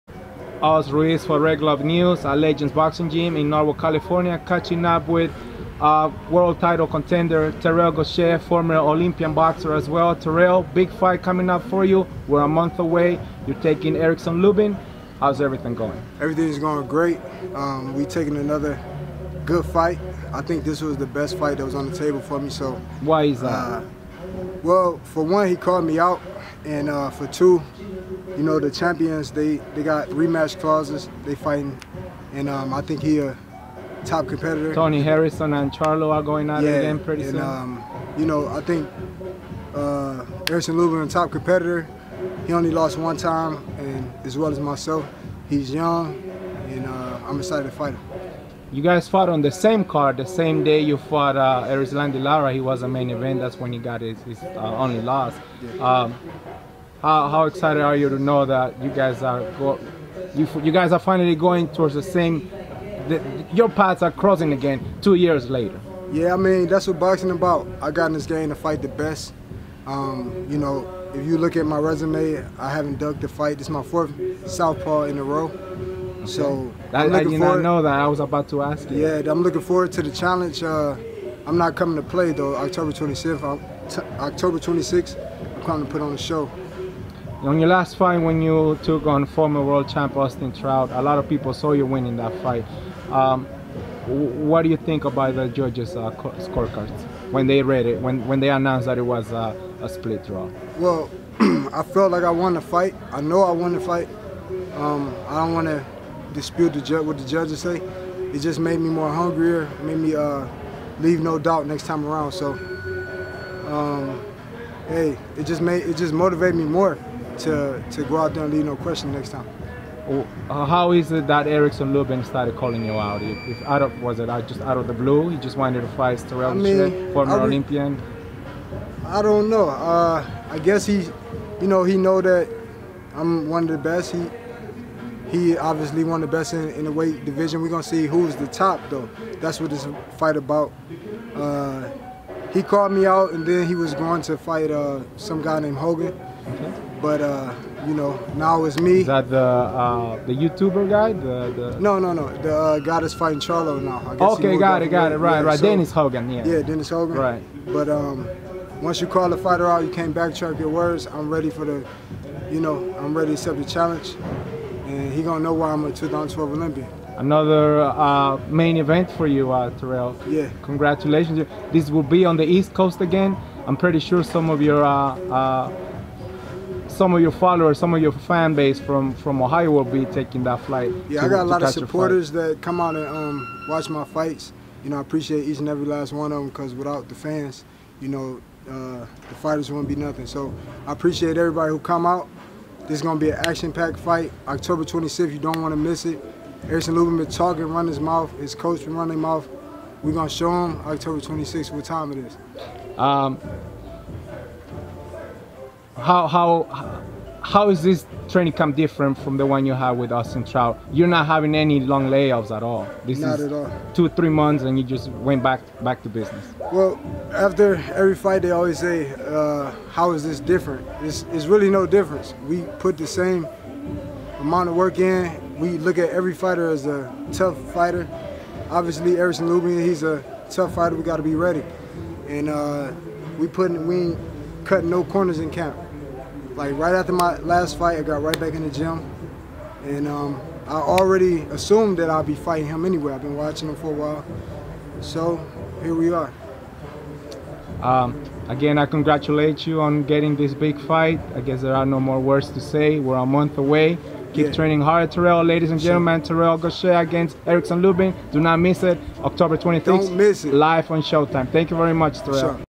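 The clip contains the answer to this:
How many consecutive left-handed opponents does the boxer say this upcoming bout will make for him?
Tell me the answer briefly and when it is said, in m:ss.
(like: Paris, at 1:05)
4, at 1:13.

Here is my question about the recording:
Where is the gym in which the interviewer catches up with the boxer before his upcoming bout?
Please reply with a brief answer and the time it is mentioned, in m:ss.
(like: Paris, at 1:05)
Norwalk, California, at 0:03.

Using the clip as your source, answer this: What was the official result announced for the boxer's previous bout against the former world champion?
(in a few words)
Split draw.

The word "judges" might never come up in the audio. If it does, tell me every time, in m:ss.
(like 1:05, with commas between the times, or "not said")
1:35, 1:47.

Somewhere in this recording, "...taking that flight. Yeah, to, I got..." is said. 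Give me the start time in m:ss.
3:00.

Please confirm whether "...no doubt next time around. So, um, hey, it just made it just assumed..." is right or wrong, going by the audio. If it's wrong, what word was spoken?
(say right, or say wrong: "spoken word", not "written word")
wrong: "motivated", not "assumed".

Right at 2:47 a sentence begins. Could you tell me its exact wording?
Another uh, main event for you, uh, Terrell.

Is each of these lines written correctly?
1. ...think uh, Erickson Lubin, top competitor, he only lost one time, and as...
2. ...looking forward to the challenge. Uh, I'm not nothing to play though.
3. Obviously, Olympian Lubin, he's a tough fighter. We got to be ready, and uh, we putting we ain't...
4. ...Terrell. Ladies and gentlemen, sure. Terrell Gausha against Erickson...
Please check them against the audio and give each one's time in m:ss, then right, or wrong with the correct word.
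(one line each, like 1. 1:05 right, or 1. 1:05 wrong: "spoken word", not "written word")
1. 0:38 right
2. 1:19 wrong: "coming", not "nothing"
3. 3:48 wrong: "Erickson", not "Olympian"
4. 4:15 right.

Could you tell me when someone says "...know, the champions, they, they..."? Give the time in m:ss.
0:28.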